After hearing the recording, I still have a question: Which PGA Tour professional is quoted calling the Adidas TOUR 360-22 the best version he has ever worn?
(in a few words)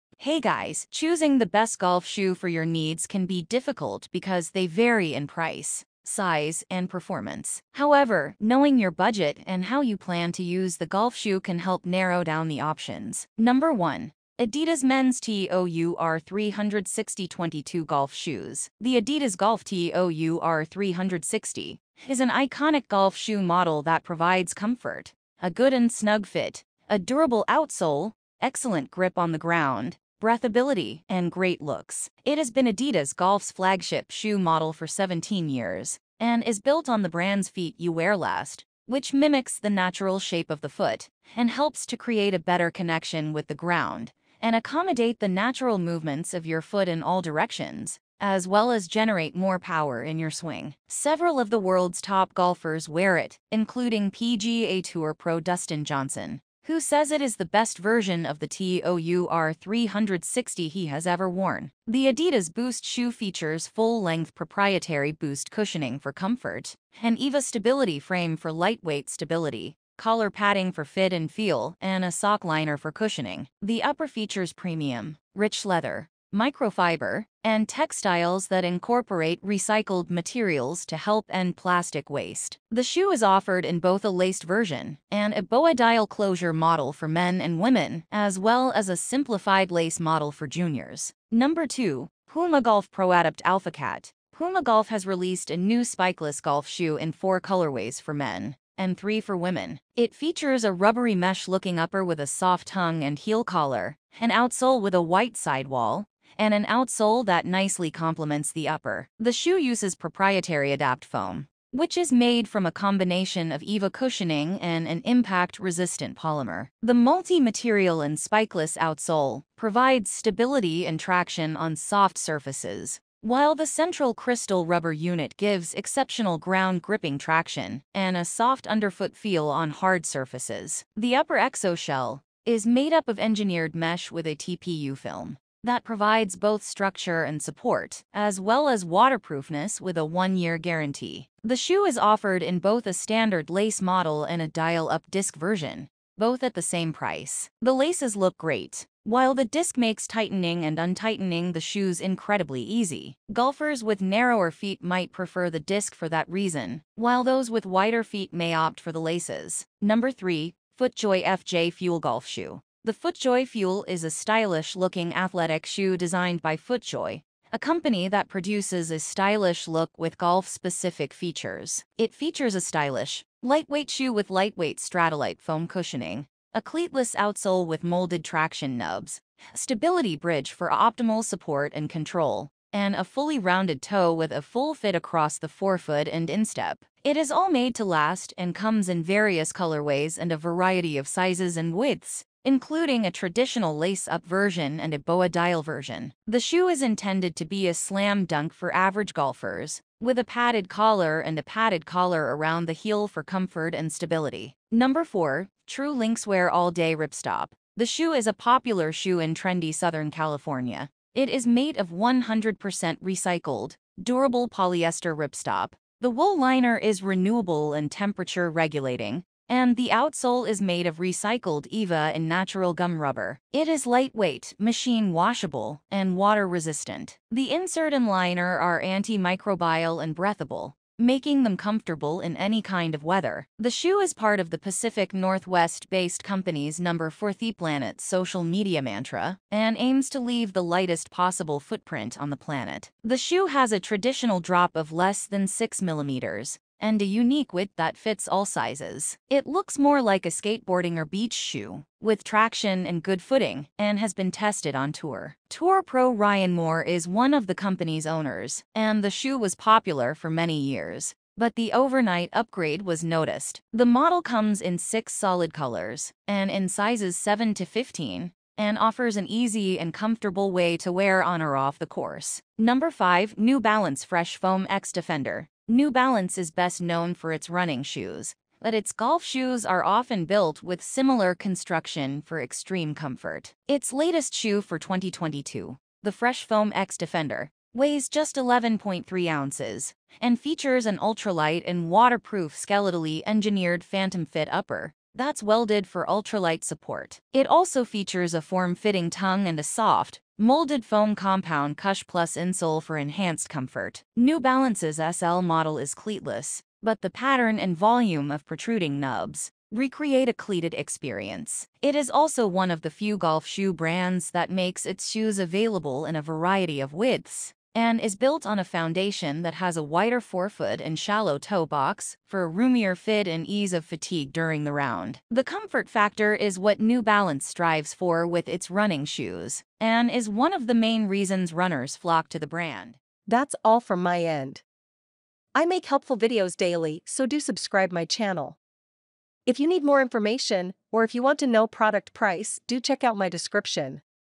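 Dustin Johnson.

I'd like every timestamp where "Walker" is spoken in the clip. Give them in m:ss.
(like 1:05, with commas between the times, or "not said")
not said.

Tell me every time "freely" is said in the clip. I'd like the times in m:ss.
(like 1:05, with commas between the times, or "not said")
not said.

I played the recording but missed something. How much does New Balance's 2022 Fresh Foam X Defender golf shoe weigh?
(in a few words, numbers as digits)
11.3 ounces.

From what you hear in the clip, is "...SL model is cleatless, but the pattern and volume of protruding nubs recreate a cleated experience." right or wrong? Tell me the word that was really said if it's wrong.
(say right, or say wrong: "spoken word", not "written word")
right.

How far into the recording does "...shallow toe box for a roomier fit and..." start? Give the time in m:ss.
5:20.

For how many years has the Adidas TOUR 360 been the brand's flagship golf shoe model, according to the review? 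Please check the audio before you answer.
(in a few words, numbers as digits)
17.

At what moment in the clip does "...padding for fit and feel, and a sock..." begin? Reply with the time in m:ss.
1:10.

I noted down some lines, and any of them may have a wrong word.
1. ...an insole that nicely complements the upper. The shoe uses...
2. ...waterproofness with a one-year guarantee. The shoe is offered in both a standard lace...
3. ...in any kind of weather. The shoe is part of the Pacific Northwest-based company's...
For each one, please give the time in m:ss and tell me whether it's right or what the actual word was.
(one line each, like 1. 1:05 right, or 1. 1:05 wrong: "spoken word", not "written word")
1. 1:46 wrong: "outsole", not "insole"
2. 2:18 right
3. 3:52 right.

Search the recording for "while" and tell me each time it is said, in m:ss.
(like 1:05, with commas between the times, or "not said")
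2:03, 2:29, 2:36.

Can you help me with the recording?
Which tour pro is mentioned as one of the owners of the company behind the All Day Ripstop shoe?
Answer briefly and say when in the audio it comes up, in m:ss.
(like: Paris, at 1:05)
Ryan Moore, at 4:16.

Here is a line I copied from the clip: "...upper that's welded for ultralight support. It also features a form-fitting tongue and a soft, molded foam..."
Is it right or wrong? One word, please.
right.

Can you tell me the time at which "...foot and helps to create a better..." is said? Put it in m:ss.
0:40.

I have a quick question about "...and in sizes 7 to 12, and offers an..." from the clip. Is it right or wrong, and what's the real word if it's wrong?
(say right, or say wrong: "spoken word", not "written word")
wrong: "15", not "12".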